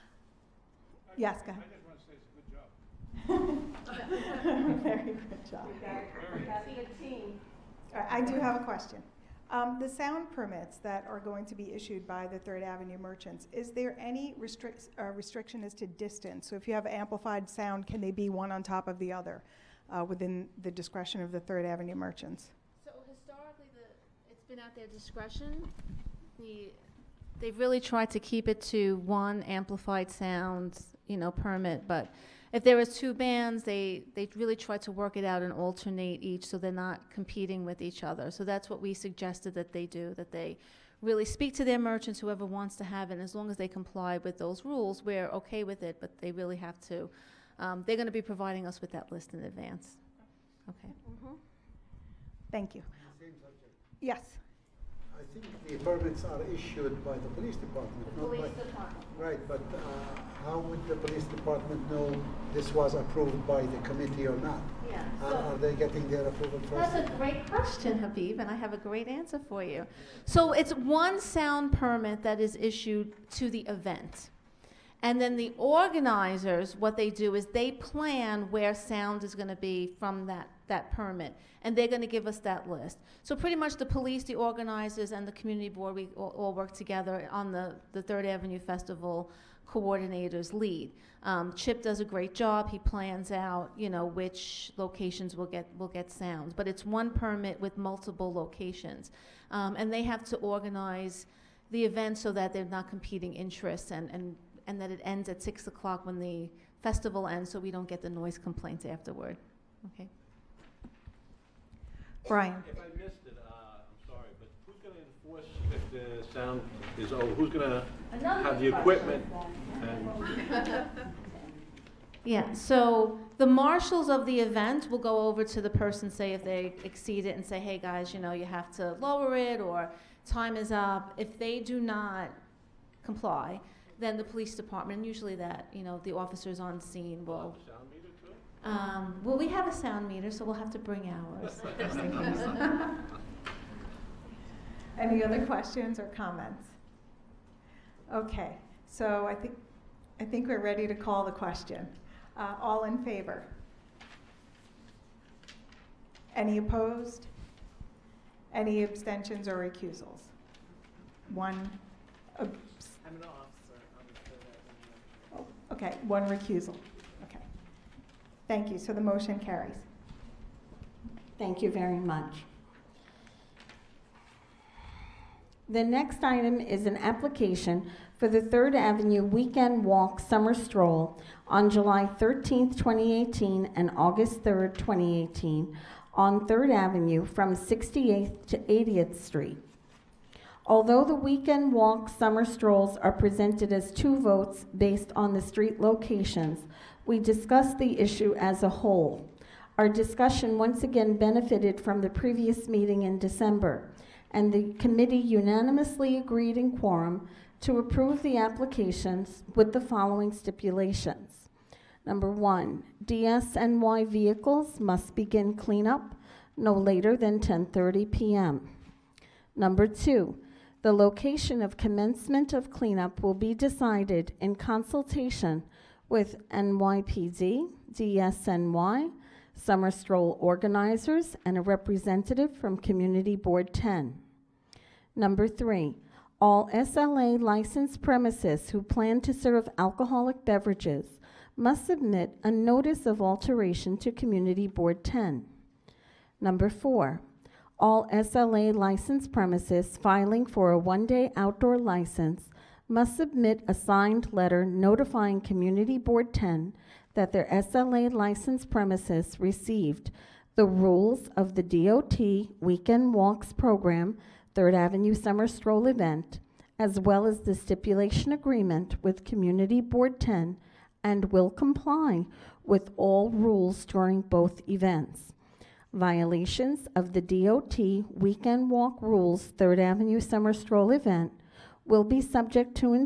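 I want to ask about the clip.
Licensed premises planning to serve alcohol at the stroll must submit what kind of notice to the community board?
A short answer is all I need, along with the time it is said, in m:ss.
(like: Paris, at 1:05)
notice of alteration, at 4:02.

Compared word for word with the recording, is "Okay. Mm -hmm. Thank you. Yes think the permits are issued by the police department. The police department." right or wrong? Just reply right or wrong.
right.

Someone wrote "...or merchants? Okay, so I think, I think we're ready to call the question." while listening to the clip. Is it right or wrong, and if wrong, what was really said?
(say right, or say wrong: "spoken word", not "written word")
wrong: "comments", not "merchants".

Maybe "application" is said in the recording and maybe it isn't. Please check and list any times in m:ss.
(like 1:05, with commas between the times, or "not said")
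2:56, 3:28.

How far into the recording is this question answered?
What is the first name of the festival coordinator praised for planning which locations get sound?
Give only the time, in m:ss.
1:31.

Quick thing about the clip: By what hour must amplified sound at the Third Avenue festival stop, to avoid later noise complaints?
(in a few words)
6:00.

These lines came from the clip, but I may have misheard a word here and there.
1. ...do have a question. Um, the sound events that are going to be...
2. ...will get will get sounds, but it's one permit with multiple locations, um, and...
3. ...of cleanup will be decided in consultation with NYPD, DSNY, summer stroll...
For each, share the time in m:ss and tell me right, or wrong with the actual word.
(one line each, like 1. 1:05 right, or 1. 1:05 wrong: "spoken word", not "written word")
1. 0:08 wrong: "permits", not "events"
2. 1:35 right
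3. 3:42 right.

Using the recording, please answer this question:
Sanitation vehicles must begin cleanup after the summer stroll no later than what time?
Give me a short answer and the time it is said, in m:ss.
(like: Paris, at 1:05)
10:30 p.m., at 3:37.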